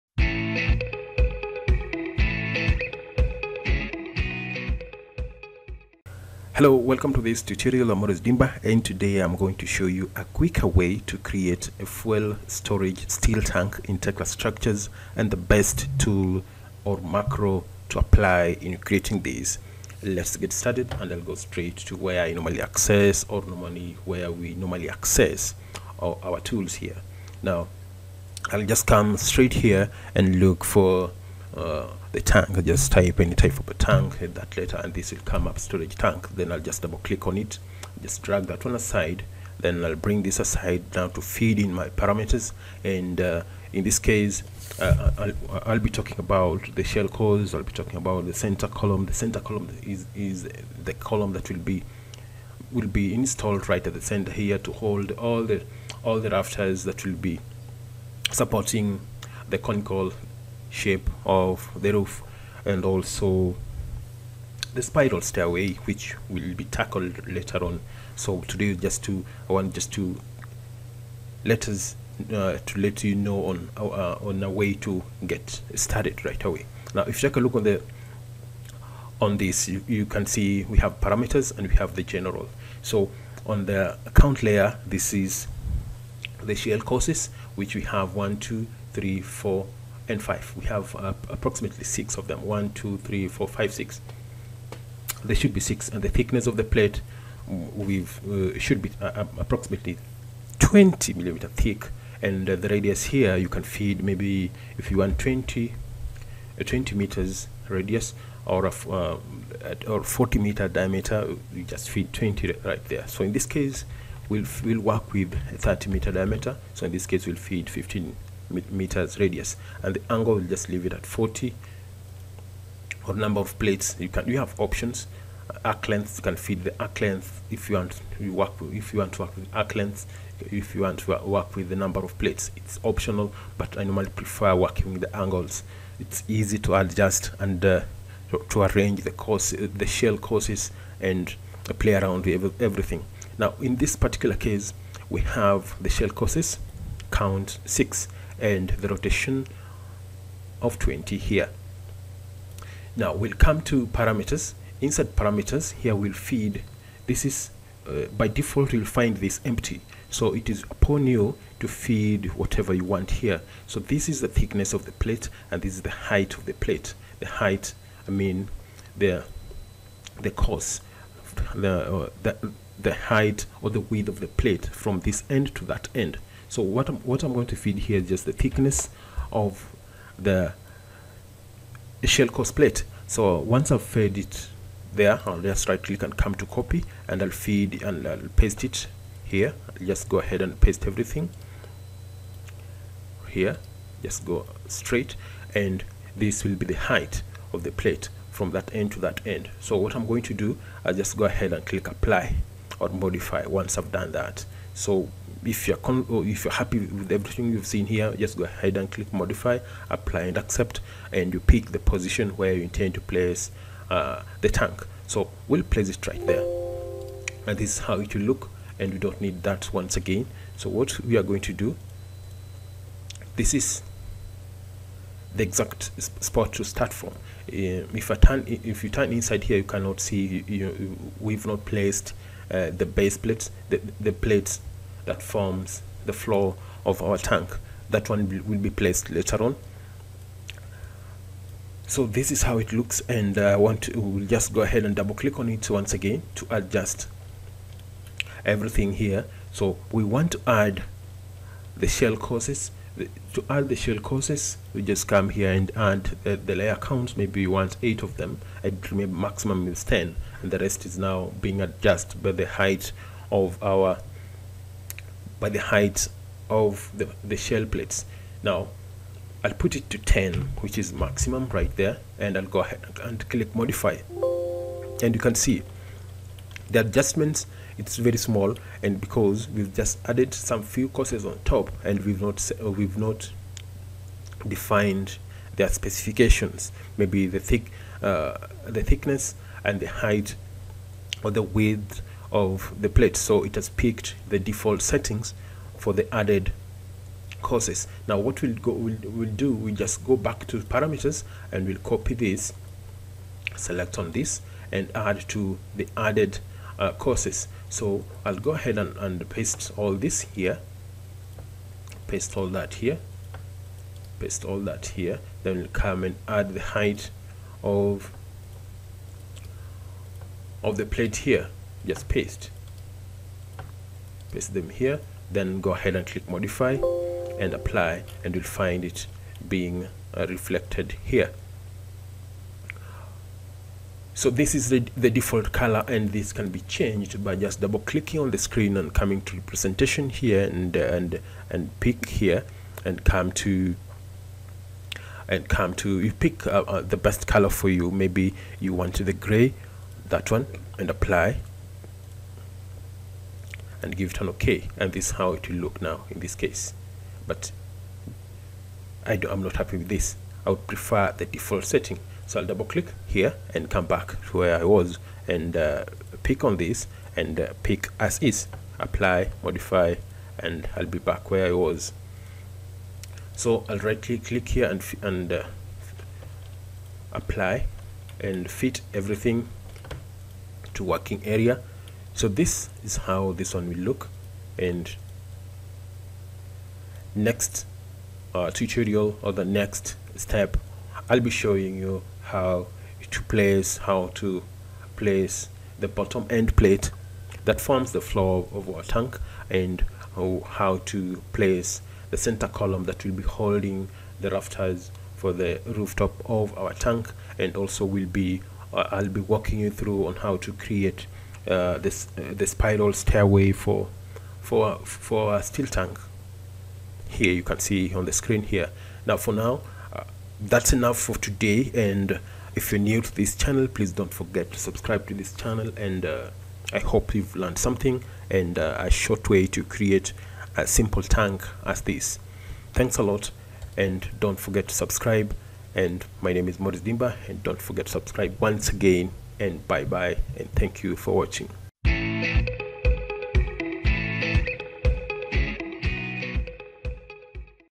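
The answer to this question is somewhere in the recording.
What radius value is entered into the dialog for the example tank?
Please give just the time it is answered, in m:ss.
1:57.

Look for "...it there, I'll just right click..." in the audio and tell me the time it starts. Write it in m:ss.
3:04.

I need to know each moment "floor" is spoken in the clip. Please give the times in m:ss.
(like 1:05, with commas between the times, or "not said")
3:56, 6:38.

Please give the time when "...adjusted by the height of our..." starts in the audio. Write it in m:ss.
4:21.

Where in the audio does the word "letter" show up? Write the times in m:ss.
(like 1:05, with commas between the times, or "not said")
0:34.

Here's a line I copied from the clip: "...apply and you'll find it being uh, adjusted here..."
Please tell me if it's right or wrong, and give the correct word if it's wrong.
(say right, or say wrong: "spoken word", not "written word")
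wrong: "reflected", not "adjusted".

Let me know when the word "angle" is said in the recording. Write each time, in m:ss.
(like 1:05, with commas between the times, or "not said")
2:00, 2:15.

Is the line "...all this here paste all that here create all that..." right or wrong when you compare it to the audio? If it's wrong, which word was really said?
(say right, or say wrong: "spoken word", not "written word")
wrong: "paste", not "create".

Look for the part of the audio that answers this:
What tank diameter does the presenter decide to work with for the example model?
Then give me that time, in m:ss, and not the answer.
1:55.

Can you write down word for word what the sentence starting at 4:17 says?
Maybe we want eight of them.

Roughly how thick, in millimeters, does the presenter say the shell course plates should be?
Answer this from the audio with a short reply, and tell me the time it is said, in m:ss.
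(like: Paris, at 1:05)
20 millimeters, at 1:40.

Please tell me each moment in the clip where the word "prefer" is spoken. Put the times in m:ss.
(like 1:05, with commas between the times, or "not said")
2:14, 6:00.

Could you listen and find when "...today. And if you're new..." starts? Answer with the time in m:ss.
7:01.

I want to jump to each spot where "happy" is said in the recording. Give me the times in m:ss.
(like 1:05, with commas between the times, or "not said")
3:26, 5:59.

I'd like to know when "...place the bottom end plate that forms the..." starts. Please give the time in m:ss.
6:34.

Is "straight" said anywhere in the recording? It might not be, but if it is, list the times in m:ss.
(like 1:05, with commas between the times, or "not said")
0:21, 0:29, 3:14.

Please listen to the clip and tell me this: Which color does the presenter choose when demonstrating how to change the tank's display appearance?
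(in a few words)
Gray.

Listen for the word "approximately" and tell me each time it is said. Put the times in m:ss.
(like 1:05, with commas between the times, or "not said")
1:31, 1:39.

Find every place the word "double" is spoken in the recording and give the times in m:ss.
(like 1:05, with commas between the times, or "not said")
0:36, 4:04, 5:37, 6:02.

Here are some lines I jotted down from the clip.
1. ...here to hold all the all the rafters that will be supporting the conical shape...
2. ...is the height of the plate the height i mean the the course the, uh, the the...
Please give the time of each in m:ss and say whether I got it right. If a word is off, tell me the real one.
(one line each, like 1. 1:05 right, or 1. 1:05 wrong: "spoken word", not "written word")
1. 0:54 right
2. 2:45 right.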